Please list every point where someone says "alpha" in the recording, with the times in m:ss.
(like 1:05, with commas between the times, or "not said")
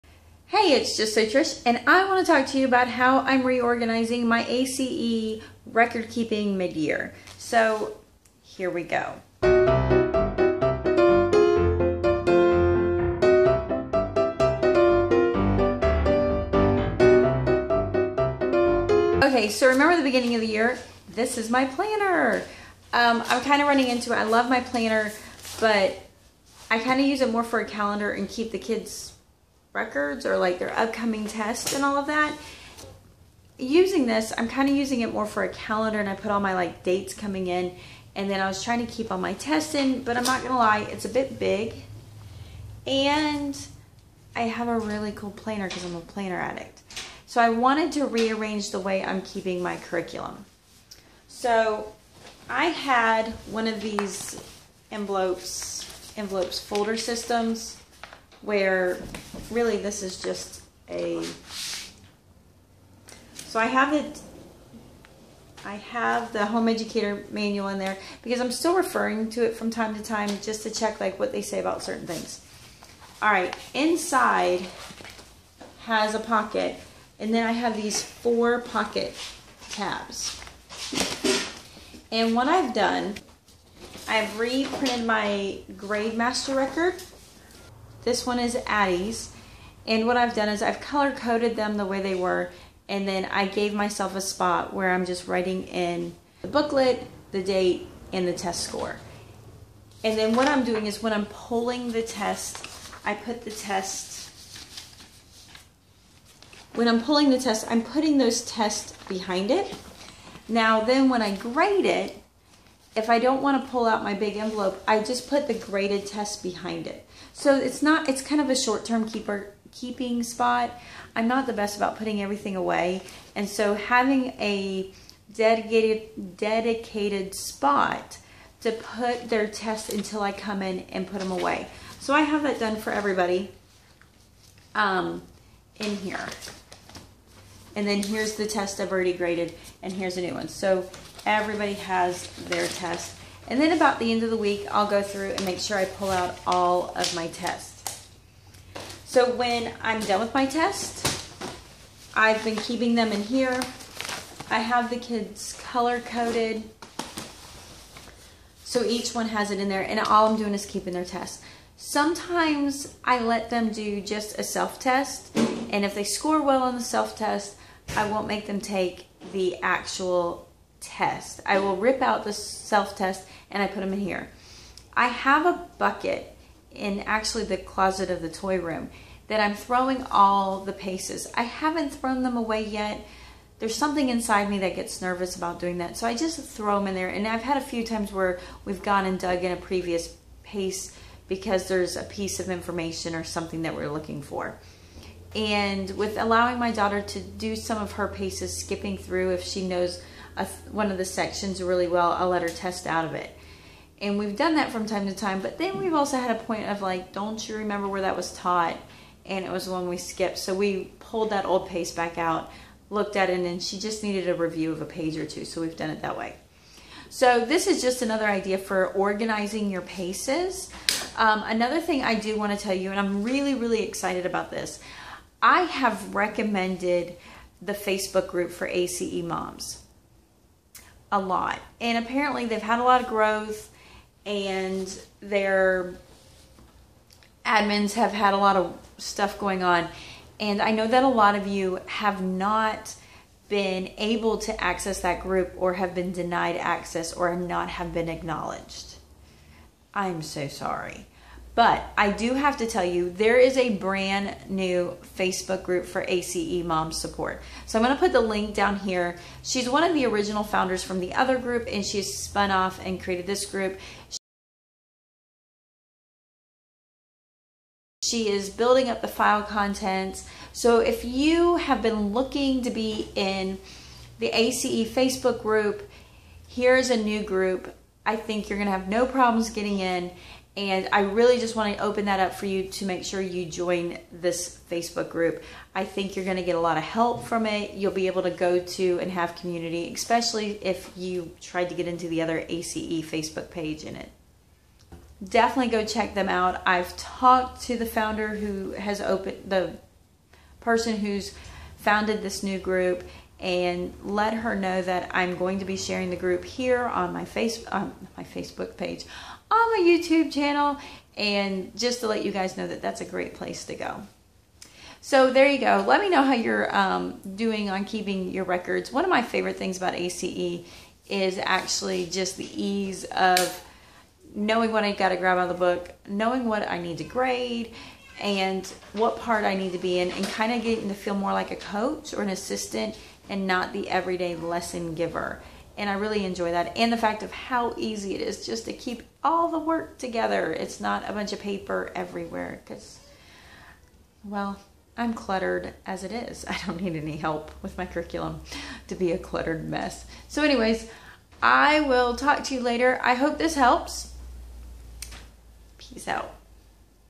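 not said.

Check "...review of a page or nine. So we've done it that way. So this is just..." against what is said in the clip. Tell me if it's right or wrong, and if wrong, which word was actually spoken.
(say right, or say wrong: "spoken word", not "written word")
wrong: "two", not "nine".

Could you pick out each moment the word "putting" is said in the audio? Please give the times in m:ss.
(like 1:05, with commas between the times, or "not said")
1:47, 2:01.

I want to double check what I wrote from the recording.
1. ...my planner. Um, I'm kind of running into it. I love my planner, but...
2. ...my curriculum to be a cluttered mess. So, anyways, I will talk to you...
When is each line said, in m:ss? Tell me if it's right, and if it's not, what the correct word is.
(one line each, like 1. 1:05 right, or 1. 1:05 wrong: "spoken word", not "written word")
1. 0:21 right
2. 5:47 right.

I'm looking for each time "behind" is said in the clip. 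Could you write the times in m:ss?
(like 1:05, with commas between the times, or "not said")
1:49, 1:56.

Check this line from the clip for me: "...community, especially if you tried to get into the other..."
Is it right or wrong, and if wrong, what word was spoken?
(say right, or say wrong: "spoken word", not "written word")
right.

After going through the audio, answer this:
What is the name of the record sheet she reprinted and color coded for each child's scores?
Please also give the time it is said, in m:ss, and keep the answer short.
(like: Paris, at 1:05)
Grade Master, at 1:25.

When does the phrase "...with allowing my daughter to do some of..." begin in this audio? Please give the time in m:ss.
3:15.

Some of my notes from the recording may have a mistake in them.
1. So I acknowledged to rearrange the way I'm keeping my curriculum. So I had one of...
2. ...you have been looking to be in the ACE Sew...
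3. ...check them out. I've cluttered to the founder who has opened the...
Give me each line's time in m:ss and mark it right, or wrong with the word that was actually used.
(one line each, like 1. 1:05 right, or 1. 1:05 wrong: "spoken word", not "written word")
1. 0:47 wrong: "wanted", not "acknowledged"
2. 4:31 wrong: "Facebook", not "Sew"
3. 4:55 wrong: "talked", not "cluttered".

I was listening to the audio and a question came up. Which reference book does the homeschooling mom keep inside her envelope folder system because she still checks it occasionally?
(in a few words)
Home educator manual.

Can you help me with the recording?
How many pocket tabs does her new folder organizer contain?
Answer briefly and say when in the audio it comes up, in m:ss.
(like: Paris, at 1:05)
4, at 1:18.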